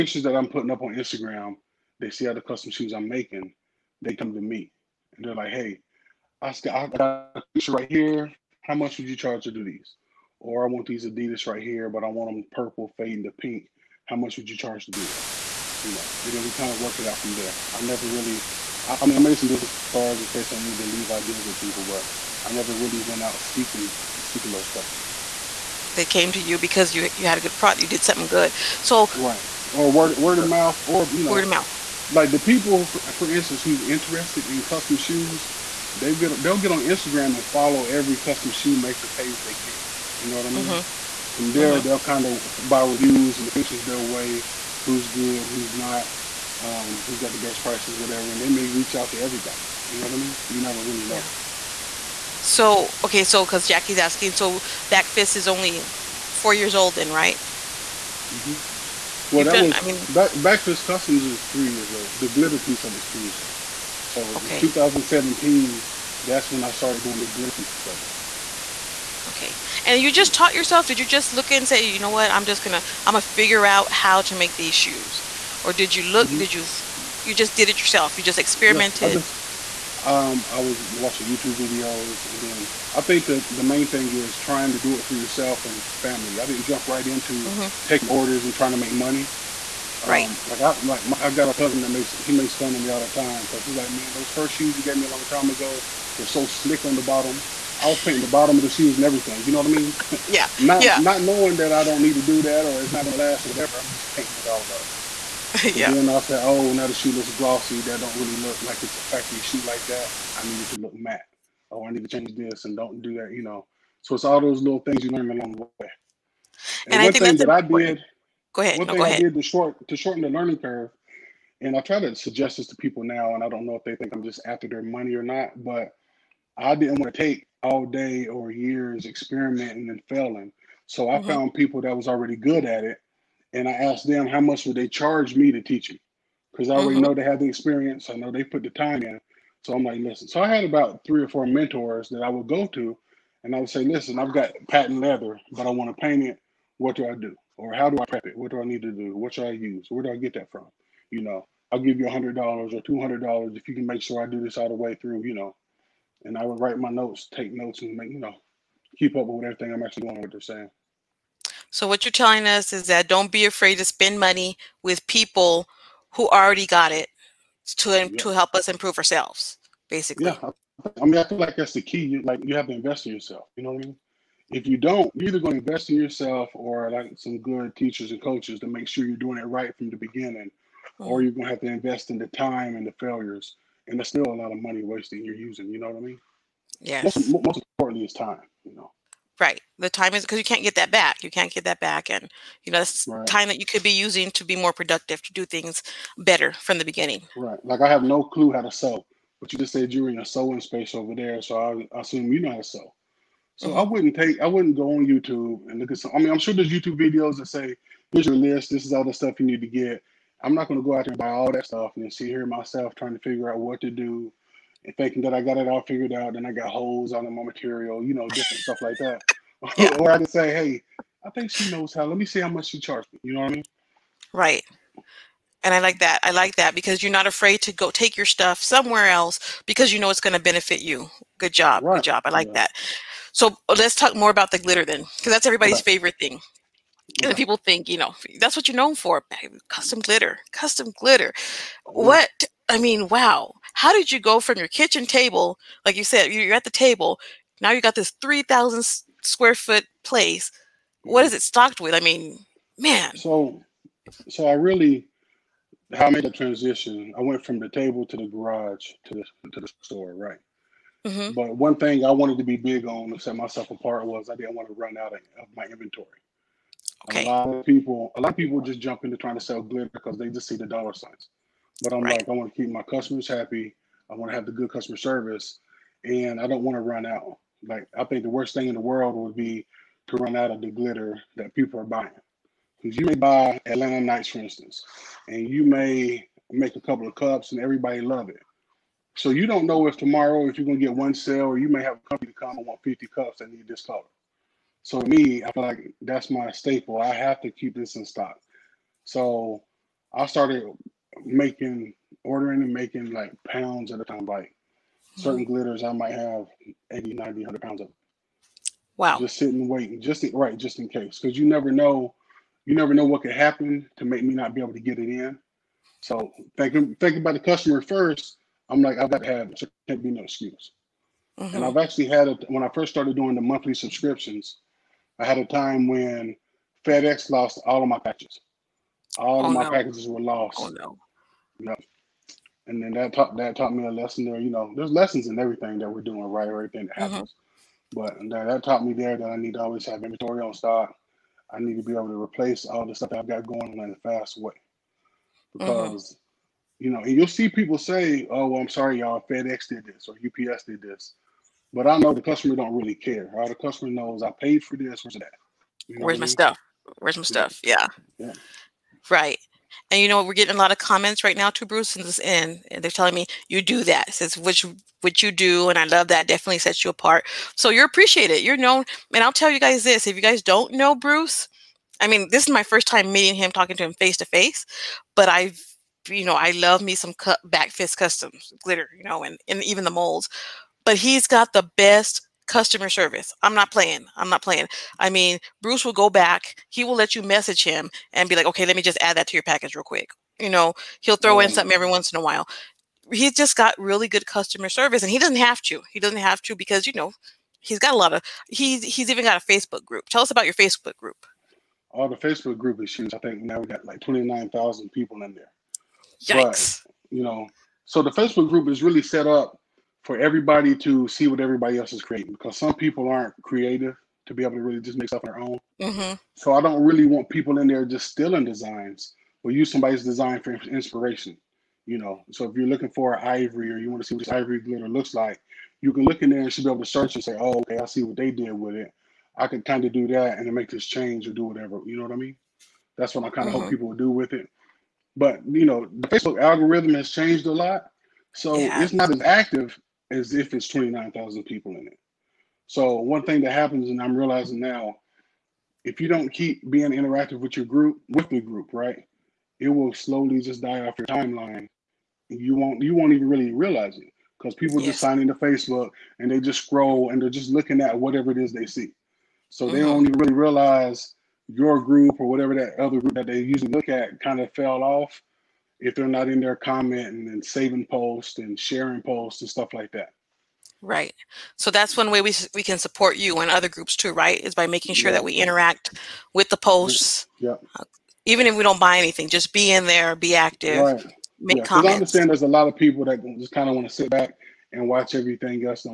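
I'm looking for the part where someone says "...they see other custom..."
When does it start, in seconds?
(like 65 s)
1 s.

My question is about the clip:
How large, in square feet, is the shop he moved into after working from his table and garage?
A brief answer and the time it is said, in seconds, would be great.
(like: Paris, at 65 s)
3,000, at 248 s.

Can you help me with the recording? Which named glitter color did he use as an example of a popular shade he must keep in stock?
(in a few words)
Atlanta Nights.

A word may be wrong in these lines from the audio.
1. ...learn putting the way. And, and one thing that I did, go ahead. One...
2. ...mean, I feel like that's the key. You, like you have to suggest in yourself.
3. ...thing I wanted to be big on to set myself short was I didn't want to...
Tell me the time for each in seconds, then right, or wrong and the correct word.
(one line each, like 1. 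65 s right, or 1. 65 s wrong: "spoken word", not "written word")
1. 115 s wrong: "along", not "putting"
2. 171 s wrong: "invest", not "suggest"
3. 261 s wrong: "apart", not "short".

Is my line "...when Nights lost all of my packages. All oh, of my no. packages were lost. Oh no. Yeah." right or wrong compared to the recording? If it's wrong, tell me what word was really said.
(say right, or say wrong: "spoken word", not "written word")
wrong: "FedEx", not "Nights".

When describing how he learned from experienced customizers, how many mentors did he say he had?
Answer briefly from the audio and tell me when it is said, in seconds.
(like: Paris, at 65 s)
3 or 4, at 141 s.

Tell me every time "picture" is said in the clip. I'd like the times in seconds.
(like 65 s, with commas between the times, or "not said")
7 s, 43 s.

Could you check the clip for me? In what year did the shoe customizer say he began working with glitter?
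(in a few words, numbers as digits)
2017.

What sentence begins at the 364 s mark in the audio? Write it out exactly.
Says which what you do, and I love that.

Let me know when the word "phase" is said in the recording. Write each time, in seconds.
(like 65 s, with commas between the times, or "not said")
not said.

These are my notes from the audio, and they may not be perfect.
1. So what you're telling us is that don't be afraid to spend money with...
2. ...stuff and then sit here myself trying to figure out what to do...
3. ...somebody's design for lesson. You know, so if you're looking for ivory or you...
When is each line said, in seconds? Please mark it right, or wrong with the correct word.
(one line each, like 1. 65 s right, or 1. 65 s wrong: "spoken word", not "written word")
1. 161 s right
2. 211 s right
3. 419 s wrong: "inspiration", not "lesson".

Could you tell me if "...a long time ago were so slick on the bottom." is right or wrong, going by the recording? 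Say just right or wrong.
right.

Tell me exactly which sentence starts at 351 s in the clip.
But I know the customer don't really care.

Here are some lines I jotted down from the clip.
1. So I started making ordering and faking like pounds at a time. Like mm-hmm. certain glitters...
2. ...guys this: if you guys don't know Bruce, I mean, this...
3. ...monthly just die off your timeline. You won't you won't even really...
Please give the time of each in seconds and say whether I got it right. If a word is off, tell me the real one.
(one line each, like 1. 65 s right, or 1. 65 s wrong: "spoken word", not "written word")
1. 299 s wrong: "making", not "faking"
2. 369 s right
3. 449 s wrong: "slowly", not "monthly".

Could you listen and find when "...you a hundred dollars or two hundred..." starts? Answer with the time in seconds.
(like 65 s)
151 s.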